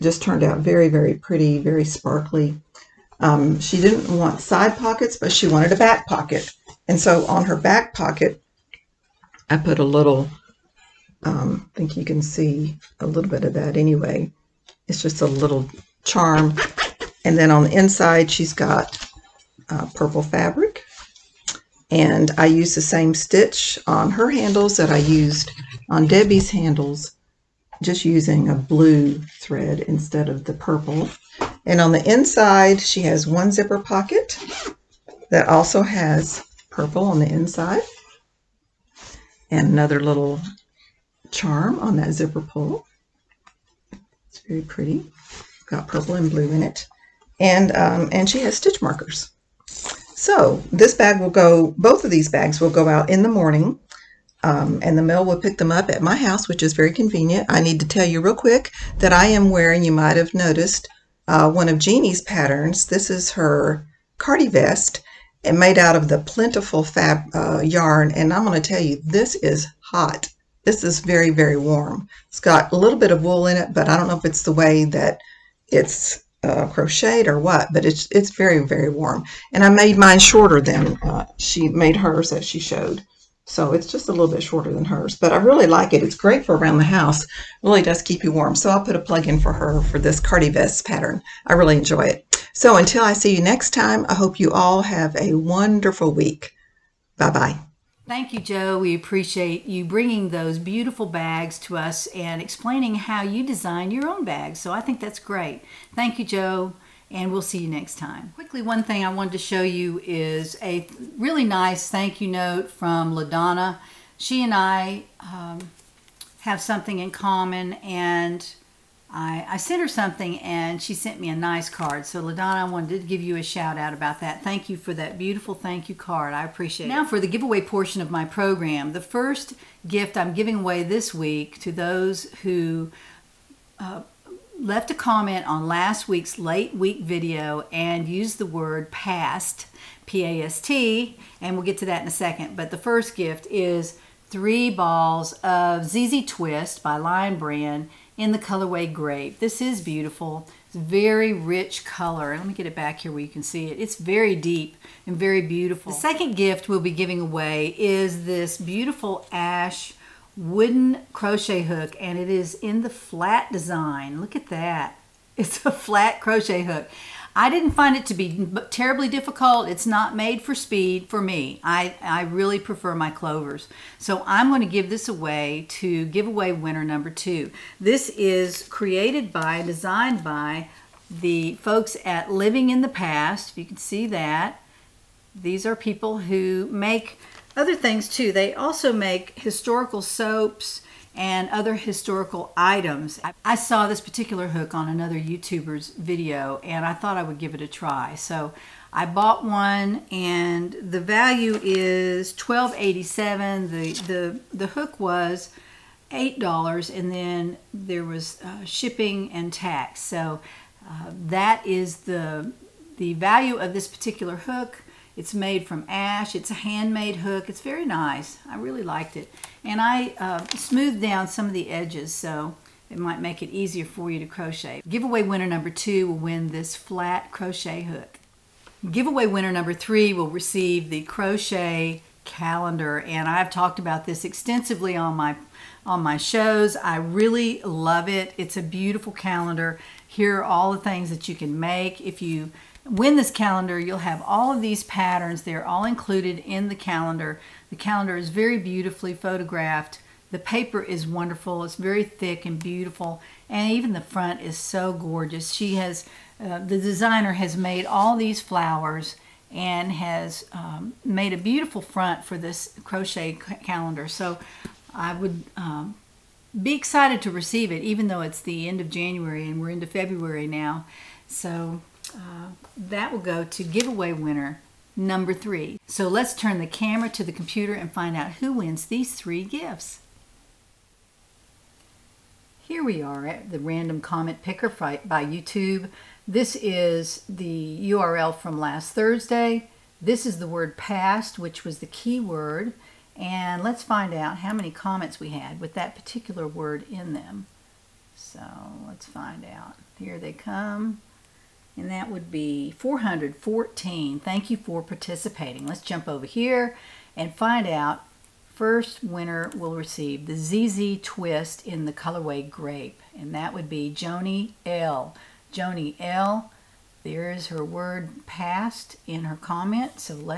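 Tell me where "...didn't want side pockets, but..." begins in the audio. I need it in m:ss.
0:03.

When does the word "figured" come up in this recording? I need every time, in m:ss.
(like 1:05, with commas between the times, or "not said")
not said.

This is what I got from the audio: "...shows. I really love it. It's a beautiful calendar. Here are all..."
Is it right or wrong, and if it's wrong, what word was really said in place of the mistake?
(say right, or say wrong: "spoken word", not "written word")
right.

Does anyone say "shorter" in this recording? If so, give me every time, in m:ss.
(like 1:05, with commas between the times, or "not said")
1:20, 1:24.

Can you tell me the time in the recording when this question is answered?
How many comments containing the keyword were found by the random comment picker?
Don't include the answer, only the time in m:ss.
5:02.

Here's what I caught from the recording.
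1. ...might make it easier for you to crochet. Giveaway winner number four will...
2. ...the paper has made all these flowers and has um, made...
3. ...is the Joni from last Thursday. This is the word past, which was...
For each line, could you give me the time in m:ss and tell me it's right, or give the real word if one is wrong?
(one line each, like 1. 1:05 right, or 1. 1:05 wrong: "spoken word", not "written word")
1. 3:42 wrong: "two", not "four"
2. 4:16 wrong: "designer", not "paper"
3. 4:46 wrong: "URL", not "Joni".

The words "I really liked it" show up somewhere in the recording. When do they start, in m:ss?
3:38.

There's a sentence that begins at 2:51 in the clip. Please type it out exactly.
I, I really prefer my clovers.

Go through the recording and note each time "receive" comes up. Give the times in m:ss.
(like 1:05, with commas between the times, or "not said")
3:50, 4:27, 5:09.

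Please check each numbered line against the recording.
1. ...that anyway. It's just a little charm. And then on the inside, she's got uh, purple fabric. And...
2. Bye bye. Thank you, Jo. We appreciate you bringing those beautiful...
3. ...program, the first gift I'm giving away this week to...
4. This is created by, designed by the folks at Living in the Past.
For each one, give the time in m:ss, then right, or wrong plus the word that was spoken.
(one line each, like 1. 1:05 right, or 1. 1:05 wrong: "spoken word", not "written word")
1. 0:13 right
2. 1:37 right
3. 2:08 right
4. 2:57 right.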